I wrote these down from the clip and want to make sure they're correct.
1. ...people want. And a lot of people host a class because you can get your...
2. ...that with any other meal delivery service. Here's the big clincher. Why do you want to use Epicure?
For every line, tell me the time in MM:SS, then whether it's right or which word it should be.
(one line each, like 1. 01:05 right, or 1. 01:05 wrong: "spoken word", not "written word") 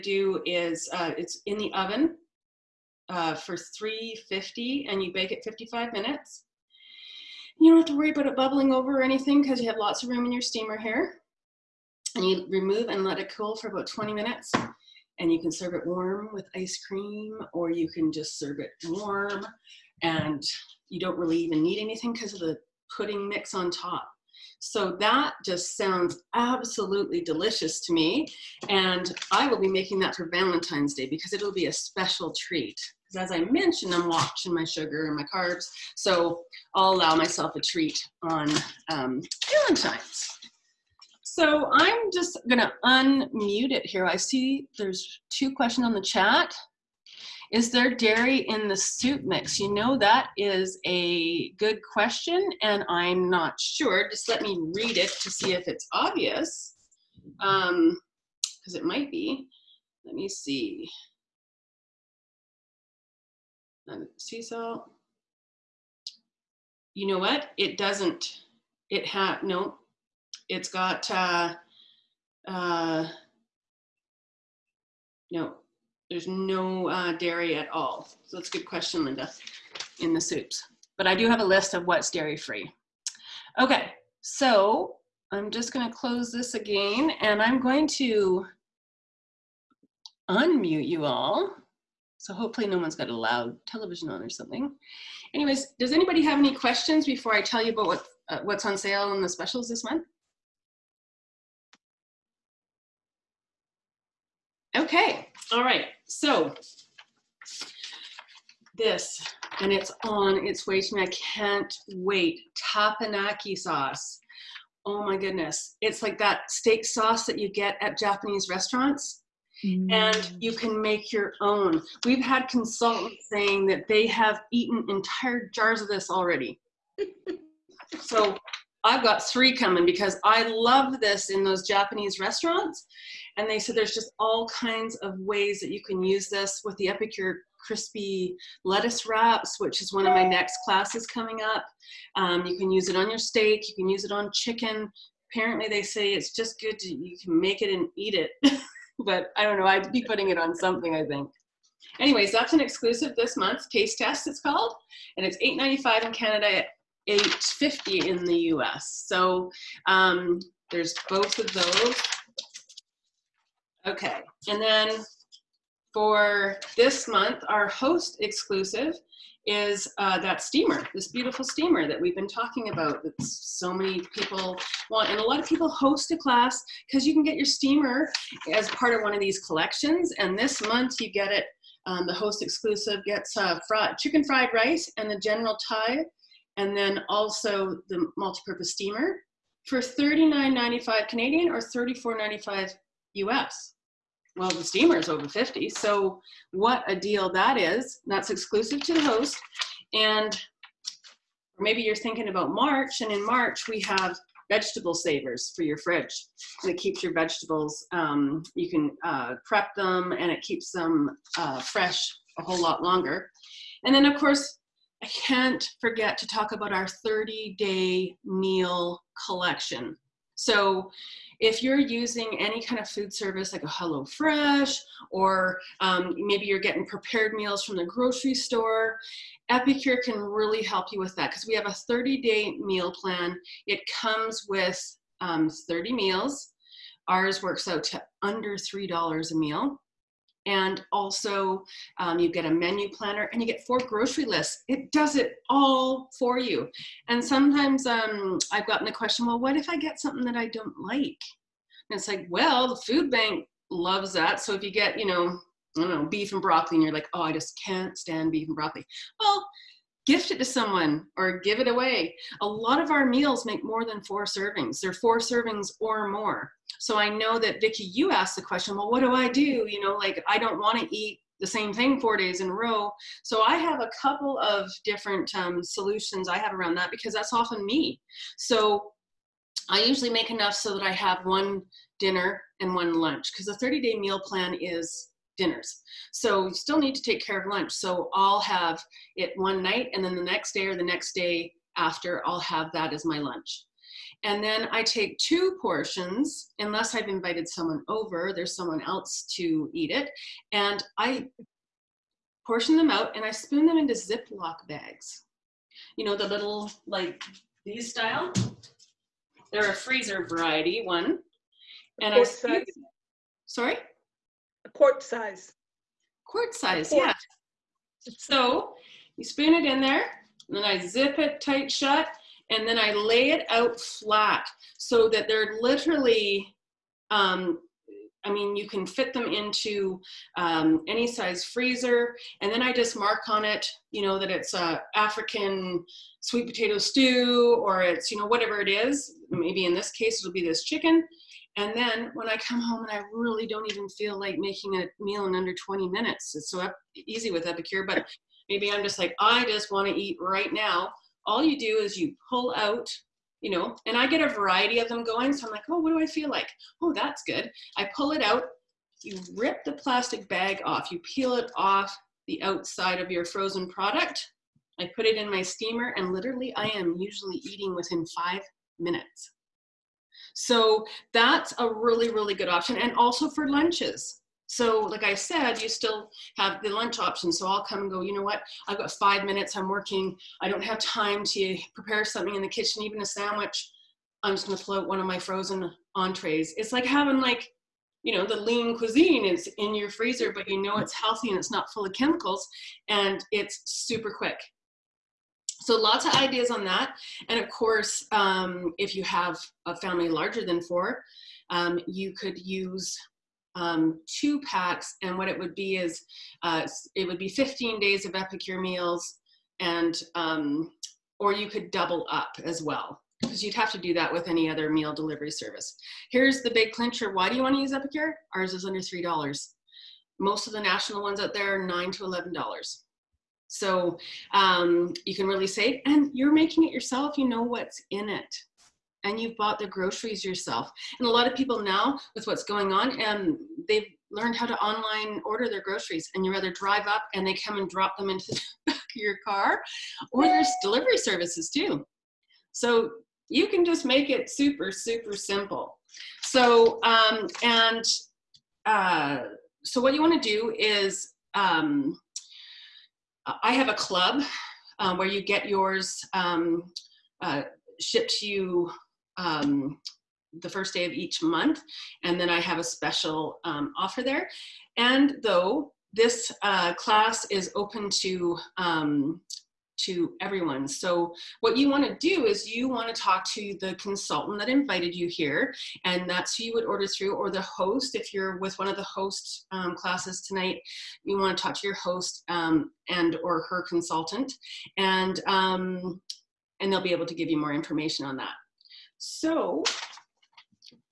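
1. 02:54 right
2. 06:53 right.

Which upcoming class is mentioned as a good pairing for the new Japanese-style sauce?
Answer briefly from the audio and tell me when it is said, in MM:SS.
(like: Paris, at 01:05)
Crispy lettuce wraps, at 02:17.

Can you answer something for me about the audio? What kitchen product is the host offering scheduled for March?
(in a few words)
Vegetable savers.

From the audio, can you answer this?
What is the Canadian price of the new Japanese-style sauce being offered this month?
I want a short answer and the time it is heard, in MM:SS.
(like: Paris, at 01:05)
$8.95, at 02:35.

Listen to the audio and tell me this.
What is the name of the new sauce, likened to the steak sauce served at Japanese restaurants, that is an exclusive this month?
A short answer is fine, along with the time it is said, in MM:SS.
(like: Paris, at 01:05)
Teppanyaki sauce, at 01:52.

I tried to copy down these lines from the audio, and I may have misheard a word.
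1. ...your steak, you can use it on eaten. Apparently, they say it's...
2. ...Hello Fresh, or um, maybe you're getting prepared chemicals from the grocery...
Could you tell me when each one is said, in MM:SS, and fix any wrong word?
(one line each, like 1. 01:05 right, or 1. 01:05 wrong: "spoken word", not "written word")
1. 02:23 wrong: "chicken", not "eaten"
2. 03:43 wrong: "meals", not "chemicals".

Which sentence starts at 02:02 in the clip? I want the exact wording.
We've had consultants saying that they have eaten entire jars of this already.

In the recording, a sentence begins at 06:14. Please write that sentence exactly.
So, like I said, you still have the lunch option.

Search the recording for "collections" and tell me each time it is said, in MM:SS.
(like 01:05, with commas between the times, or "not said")
02:59, 03:39.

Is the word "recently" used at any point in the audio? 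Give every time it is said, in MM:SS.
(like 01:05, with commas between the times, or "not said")
not said.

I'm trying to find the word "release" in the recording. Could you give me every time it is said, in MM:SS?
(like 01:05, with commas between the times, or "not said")
not said.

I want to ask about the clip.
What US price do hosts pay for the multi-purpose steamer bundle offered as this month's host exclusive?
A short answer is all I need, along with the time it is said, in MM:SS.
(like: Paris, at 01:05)
$34.95, at 03:11.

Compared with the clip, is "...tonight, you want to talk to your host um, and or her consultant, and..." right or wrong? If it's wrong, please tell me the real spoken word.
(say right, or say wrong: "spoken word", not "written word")
right.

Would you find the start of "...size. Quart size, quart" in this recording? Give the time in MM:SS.
05:15.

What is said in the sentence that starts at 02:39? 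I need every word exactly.
So um, there's both of those.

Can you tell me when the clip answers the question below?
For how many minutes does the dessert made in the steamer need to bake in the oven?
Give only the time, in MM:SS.
00:05.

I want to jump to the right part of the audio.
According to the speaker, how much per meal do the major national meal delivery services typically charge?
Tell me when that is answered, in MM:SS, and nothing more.
07:01.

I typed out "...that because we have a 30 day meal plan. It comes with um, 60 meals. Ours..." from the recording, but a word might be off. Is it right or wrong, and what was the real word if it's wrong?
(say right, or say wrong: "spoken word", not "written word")
wrong: "30", not "60".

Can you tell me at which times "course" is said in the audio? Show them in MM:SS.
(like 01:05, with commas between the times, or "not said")
03:34, 06:37.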